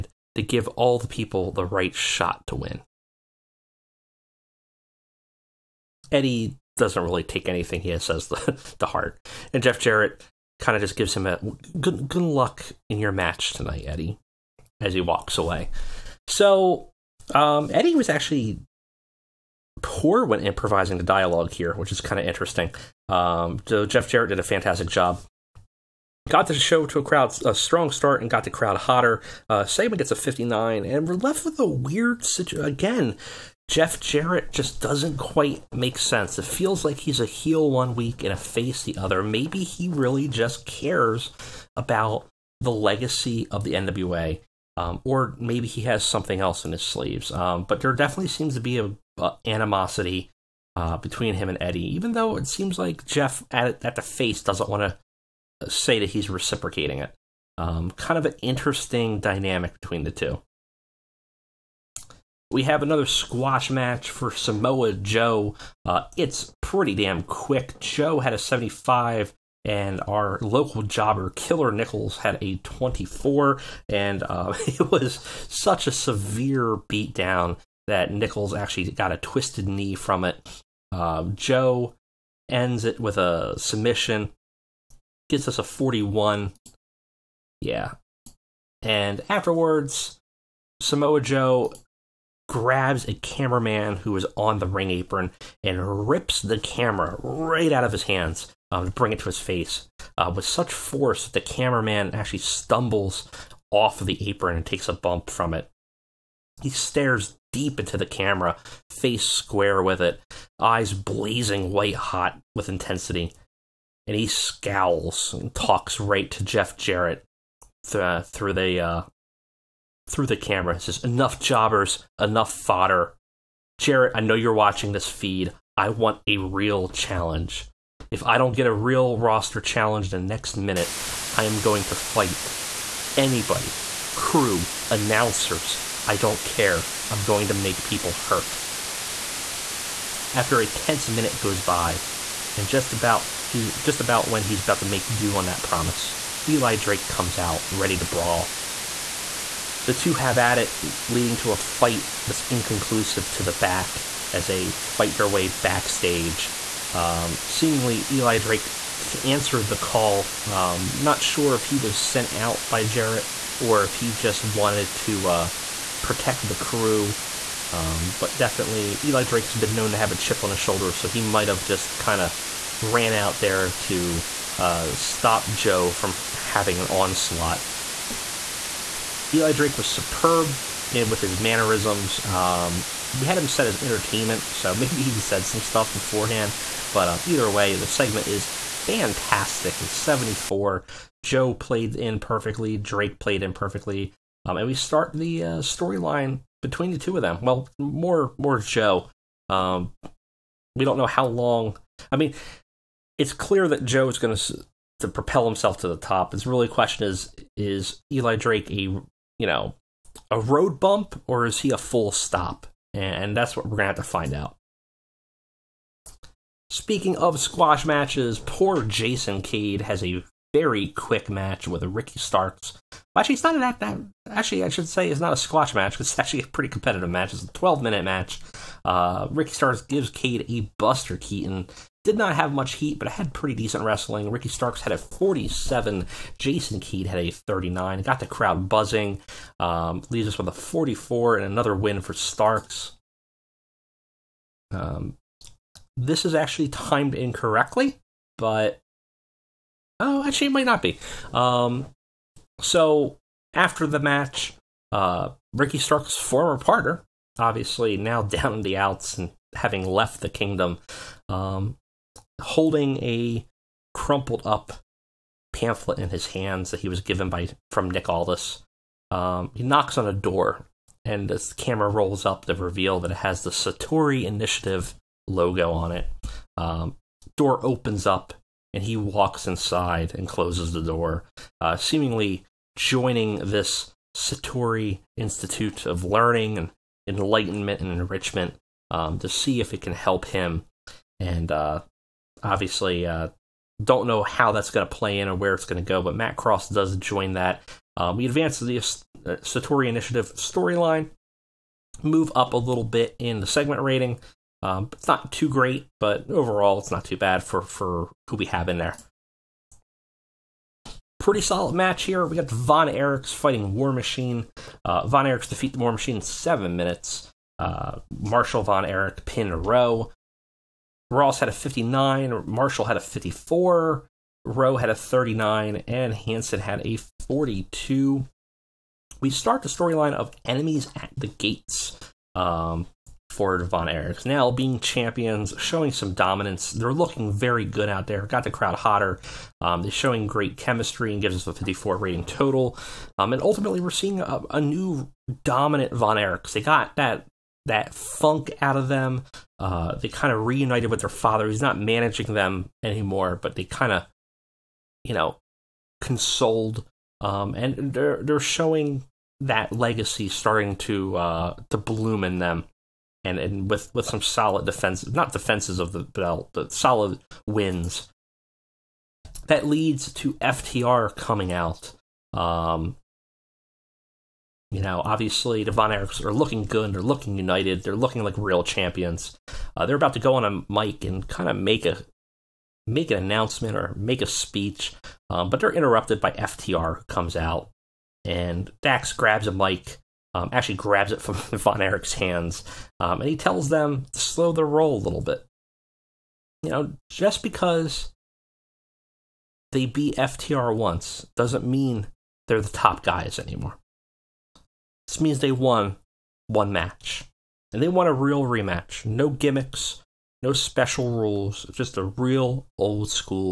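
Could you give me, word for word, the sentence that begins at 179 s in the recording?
Eli Drake was superb eh, with his mannerisms.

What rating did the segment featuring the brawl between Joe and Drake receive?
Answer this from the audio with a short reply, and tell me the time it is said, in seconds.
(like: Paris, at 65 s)
74, at 189 s.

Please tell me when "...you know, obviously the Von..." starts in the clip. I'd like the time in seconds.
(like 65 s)
374 s.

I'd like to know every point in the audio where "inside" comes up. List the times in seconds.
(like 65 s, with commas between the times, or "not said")
279 s.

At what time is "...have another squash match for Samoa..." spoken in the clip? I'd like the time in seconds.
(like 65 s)
62 s.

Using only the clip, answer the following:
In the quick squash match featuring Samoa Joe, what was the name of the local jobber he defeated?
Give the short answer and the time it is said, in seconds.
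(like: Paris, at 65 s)
Killer Nichols, at 71 s.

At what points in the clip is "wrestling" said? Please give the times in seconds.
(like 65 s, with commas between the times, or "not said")
233 s.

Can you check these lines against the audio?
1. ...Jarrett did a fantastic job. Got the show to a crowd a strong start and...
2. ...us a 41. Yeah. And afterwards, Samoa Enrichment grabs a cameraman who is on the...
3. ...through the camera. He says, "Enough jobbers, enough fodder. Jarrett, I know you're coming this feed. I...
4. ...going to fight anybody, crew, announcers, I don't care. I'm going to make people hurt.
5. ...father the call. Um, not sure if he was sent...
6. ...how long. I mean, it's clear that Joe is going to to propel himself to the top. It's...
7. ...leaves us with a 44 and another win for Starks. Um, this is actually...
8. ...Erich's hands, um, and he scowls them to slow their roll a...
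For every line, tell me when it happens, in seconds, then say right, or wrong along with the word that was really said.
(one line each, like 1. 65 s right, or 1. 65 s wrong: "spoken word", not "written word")
1. 24 s right
2. 85 s wrong: "Joe", not "Enrichment"
3. 120 s wrong: "watching", not "coming"
4. 131 s right
5. 159 s wrong: "answer", not "father"
6. 201 s right
7. 240 s right
8. 391 s wrong: "tells", not "scowls".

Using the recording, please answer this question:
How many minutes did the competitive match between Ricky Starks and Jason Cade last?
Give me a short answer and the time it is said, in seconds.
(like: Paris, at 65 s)
12, at 227 s.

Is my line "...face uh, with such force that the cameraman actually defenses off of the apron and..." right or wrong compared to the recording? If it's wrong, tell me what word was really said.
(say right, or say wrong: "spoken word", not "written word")
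wrong: "stumbles", not "defenses".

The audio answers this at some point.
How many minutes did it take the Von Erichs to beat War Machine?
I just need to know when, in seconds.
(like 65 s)
316 s.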